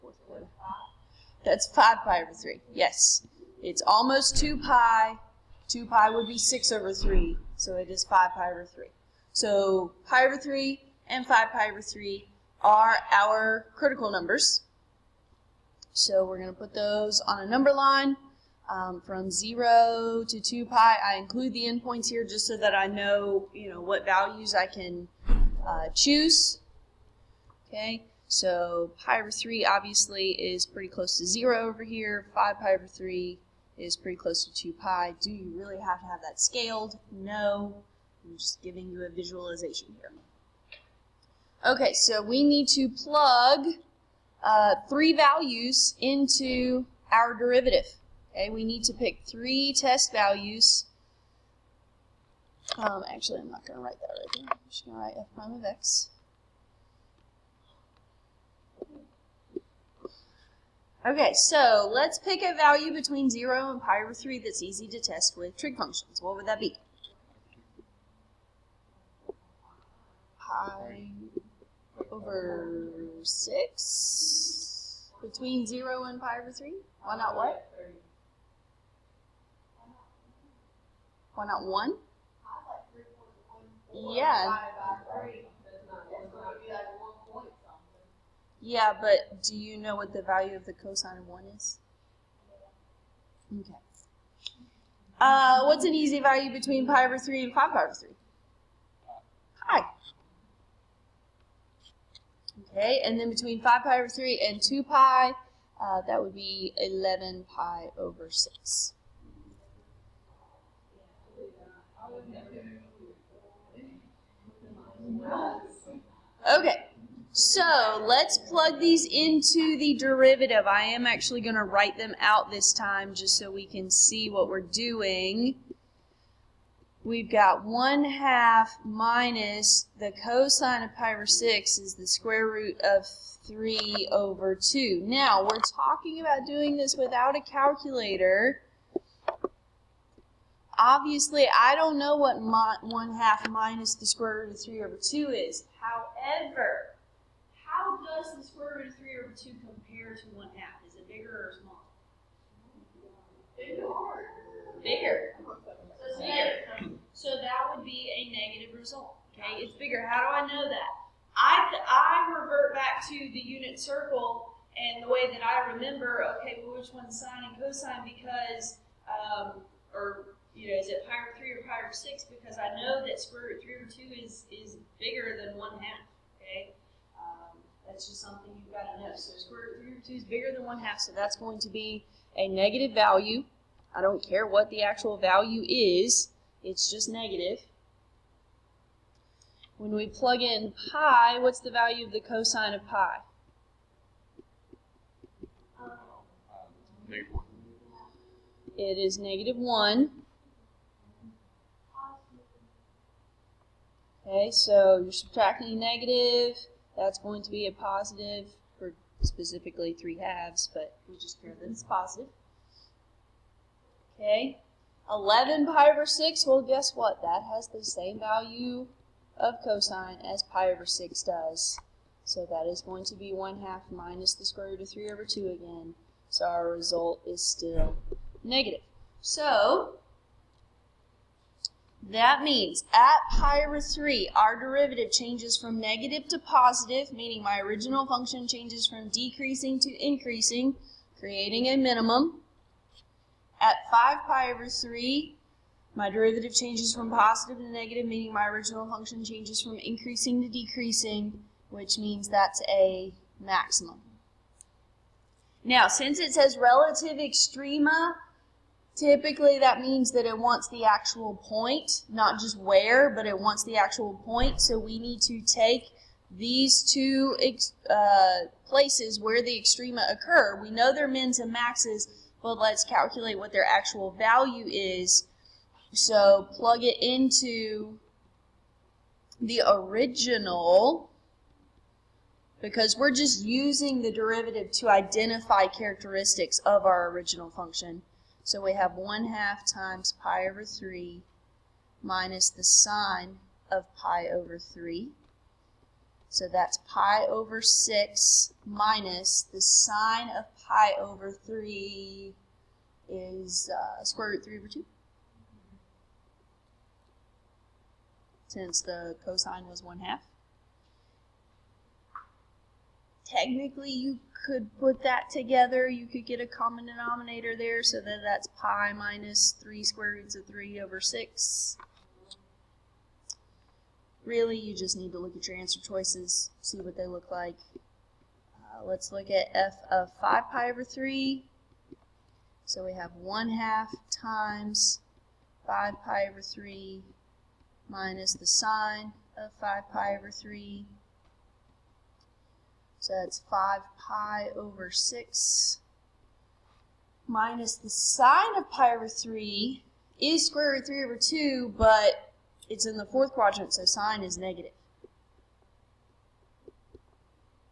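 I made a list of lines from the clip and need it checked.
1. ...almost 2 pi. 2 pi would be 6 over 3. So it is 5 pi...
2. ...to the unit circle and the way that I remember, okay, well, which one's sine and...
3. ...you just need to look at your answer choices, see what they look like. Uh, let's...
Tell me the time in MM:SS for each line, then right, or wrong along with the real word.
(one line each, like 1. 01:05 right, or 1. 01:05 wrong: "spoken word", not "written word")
1. 00:03 right
2. 02:43 right
3. 05:24 right.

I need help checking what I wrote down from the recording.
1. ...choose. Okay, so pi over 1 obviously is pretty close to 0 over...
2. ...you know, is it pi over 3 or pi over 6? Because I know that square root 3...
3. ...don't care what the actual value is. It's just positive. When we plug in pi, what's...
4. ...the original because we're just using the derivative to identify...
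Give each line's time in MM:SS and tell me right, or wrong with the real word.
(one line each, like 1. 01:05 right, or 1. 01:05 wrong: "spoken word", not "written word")
1. 00:25 wrong: "3", not "1"
2. 02:50 right
3. 03:04 wrong: "negative", not "positive"
4. 04:39 right.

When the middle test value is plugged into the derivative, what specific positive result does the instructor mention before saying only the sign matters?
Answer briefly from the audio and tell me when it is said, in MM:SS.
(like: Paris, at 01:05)
3 halves, at 03:29.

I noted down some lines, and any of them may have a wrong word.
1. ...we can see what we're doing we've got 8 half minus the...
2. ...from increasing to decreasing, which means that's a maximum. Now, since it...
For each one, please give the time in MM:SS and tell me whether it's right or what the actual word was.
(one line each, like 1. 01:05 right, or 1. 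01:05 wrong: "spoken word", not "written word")
1. 02:03 wrong: "1", not "8"
2. 04:09 right.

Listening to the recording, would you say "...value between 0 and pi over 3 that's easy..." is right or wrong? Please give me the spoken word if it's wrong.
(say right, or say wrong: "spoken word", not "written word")
right.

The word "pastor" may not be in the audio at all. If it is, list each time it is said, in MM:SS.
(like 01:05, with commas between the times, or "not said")
not said.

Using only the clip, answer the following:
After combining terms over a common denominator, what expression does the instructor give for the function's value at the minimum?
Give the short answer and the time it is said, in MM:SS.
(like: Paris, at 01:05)
pi minus 3 root 3 over 6, at 05:18.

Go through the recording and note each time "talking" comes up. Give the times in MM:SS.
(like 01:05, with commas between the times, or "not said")
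02:15.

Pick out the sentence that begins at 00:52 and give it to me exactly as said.
Um, actually, I'm not going to write that right here.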